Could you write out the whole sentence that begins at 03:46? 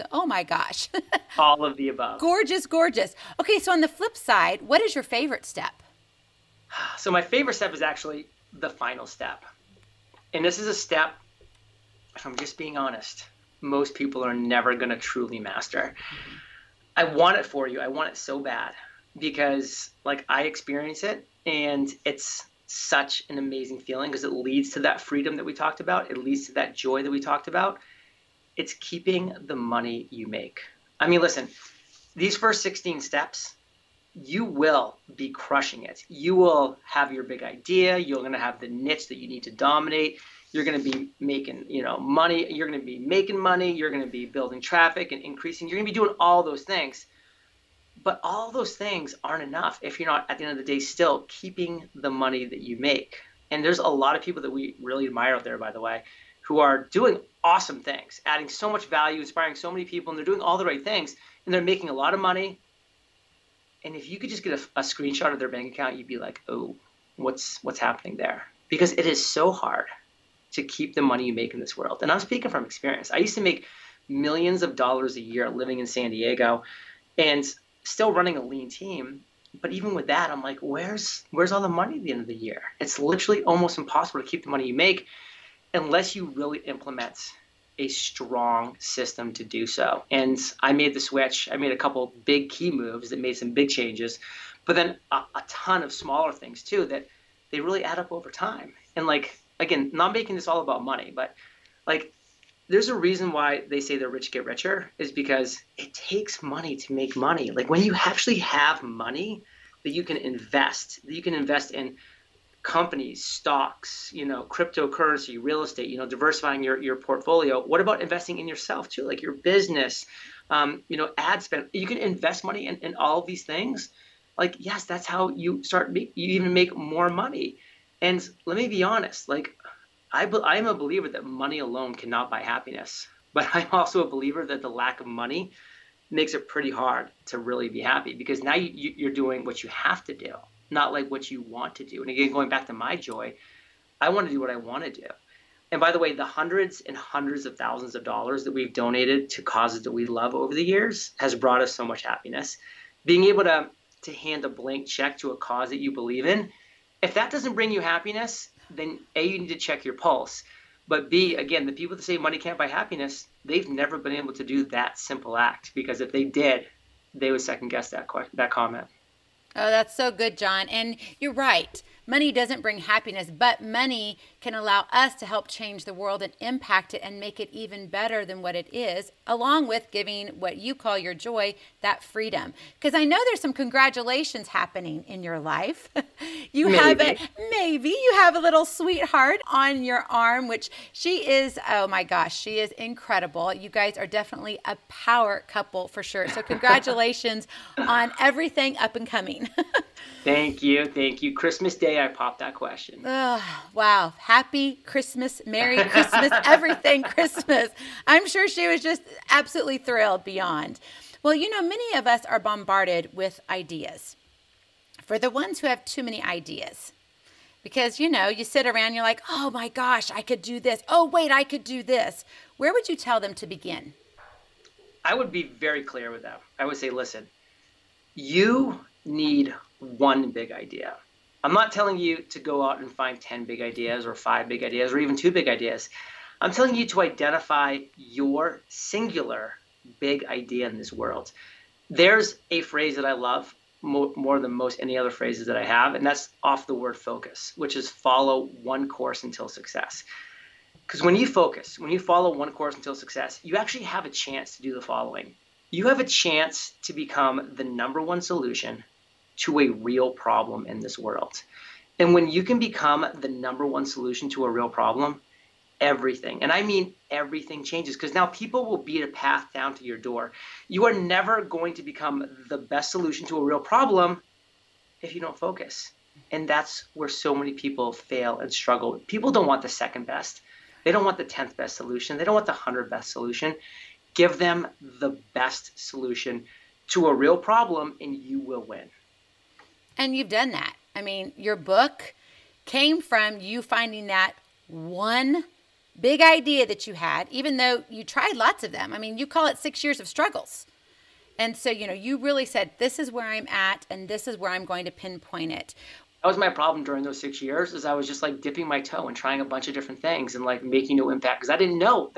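I would say, listen, you need one big idea.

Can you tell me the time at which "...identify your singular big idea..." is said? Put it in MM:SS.
03:57.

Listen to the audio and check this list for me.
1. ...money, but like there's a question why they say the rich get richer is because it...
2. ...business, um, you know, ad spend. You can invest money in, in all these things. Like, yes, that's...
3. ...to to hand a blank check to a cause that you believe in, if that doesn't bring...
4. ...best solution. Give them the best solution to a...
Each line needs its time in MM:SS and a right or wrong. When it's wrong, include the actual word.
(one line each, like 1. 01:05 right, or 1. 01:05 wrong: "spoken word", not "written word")
1. 01:40 wrong: "reason", not "question"
2. 01:59 right
3. 02:33 right
4. 04:42 right.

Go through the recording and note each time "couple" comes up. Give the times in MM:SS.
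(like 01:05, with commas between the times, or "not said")
01:31, 03:15.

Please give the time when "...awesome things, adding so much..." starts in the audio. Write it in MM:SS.
00:57.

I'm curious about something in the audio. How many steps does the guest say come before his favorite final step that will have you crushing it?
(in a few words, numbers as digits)
16.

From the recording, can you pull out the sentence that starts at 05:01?
And so, you know, you really said, this is where I'm at and this is where I'm going to pinpoint it.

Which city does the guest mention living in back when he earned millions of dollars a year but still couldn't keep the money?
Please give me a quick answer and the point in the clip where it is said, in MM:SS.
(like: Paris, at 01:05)
San Diego, at 01:15.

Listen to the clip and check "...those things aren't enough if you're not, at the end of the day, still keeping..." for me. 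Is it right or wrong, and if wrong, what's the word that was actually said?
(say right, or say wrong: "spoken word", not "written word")
right.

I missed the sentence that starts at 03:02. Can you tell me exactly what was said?
Because I know there's some congratulations happening in your life.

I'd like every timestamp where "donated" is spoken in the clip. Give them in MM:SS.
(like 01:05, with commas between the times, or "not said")
02:28.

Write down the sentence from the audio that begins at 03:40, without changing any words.
Oh, wait, I could do this.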